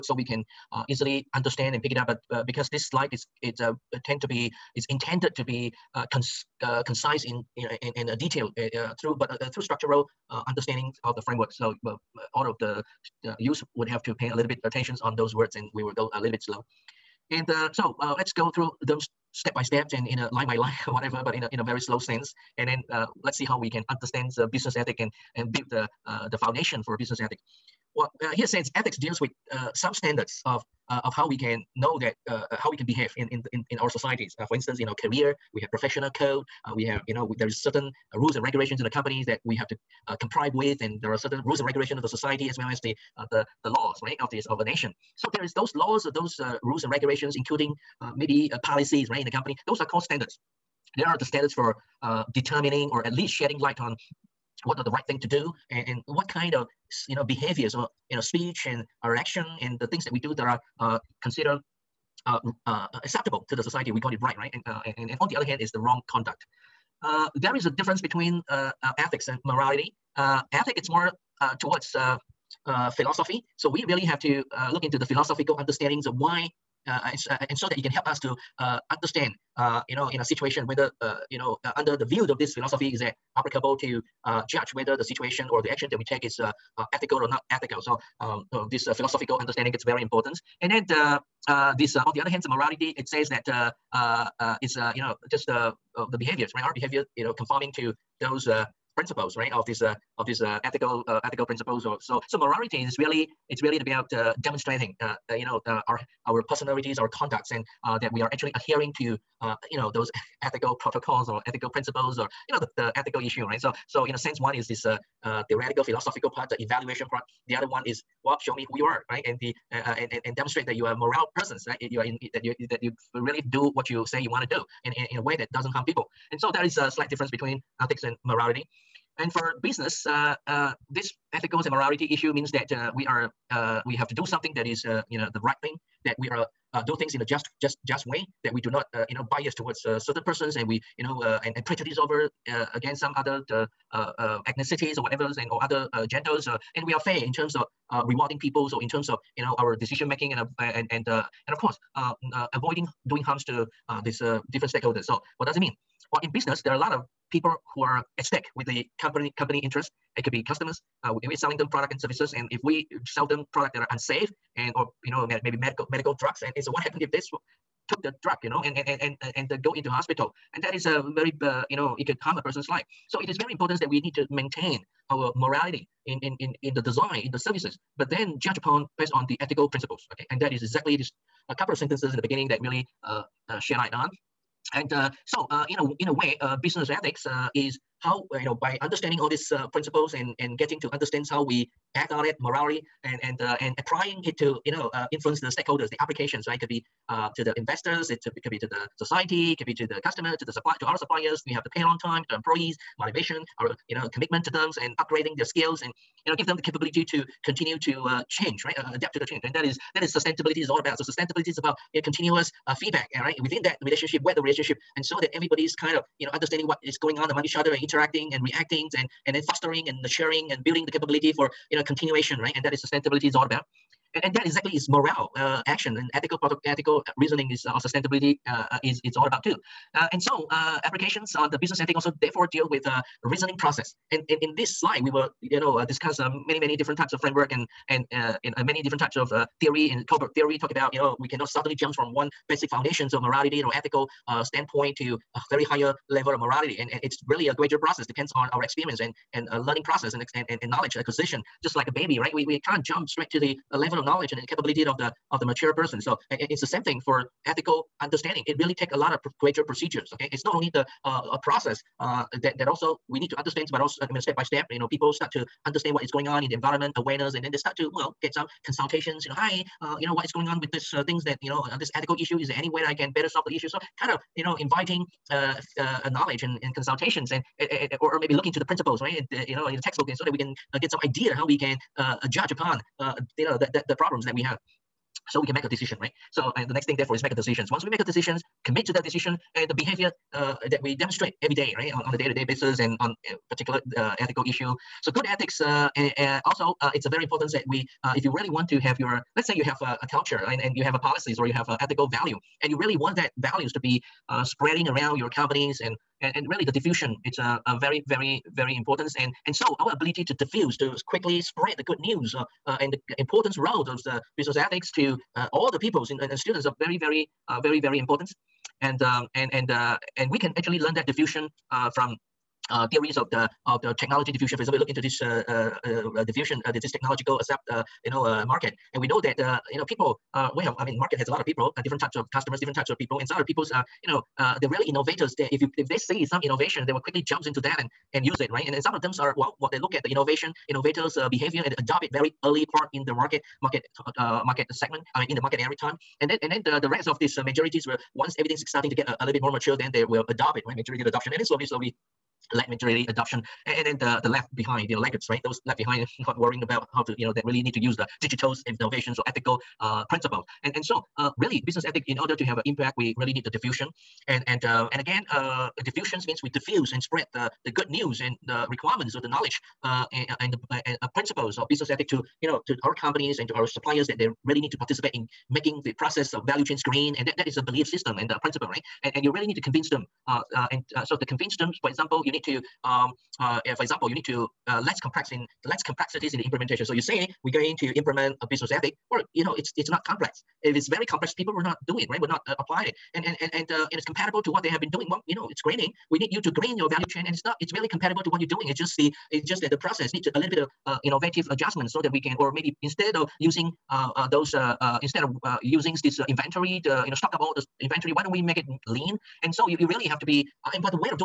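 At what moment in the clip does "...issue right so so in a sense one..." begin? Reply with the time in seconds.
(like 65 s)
113 s.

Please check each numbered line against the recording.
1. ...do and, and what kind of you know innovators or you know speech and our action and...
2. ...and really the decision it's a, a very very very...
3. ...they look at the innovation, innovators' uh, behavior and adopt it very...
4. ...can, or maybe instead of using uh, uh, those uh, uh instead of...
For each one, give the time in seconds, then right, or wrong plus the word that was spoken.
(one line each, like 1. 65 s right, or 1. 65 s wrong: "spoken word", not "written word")
1. 55 s wrong: "behaviors", not "innovators"
2. 306 s wrong: "diffusion", not "decision"
3. 339 s right
4. 402 s right.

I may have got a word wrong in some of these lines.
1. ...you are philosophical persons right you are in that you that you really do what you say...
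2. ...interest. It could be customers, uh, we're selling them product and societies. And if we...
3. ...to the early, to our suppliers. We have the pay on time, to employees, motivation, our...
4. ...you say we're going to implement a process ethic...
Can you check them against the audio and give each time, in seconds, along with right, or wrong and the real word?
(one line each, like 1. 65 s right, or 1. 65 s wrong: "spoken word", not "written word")
1. 120 s wrong: "moral", not "philosophical"
2. 159 s wrong: "services", not "societies"
3. 200 s wrong: "supply", not "early"
4. 386 s wrong: "business", not "process".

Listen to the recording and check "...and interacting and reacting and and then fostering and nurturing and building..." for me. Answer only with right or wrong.
right.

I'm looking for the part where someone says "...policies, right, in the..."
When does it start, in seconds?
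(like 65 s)
48 s.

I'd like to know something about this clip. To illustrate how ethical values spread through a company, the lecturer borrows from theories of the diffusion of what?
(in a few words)
Technology.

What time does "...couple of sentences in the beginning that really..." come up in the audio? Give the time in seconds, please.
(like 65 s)
181 s.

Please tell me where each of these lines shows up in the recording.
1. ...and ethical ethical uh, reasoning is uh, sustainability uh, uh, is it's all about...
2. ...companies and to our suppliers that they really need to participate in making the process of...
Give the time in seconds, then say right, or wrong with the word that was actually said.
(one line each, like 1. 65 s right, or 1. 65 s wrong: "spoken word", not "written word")
1. 225 s right
2. 372 s right.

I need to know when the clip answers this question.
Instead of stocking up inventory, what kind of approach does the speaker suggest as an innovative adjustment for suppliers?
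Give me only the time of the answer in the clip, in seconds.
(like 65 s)
408 s.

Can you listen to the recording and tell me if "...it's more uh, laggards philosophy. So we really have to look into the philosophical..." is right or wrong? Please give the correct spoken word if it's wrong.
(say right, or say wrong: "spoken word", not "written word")
wrong: "towards", not "laggards".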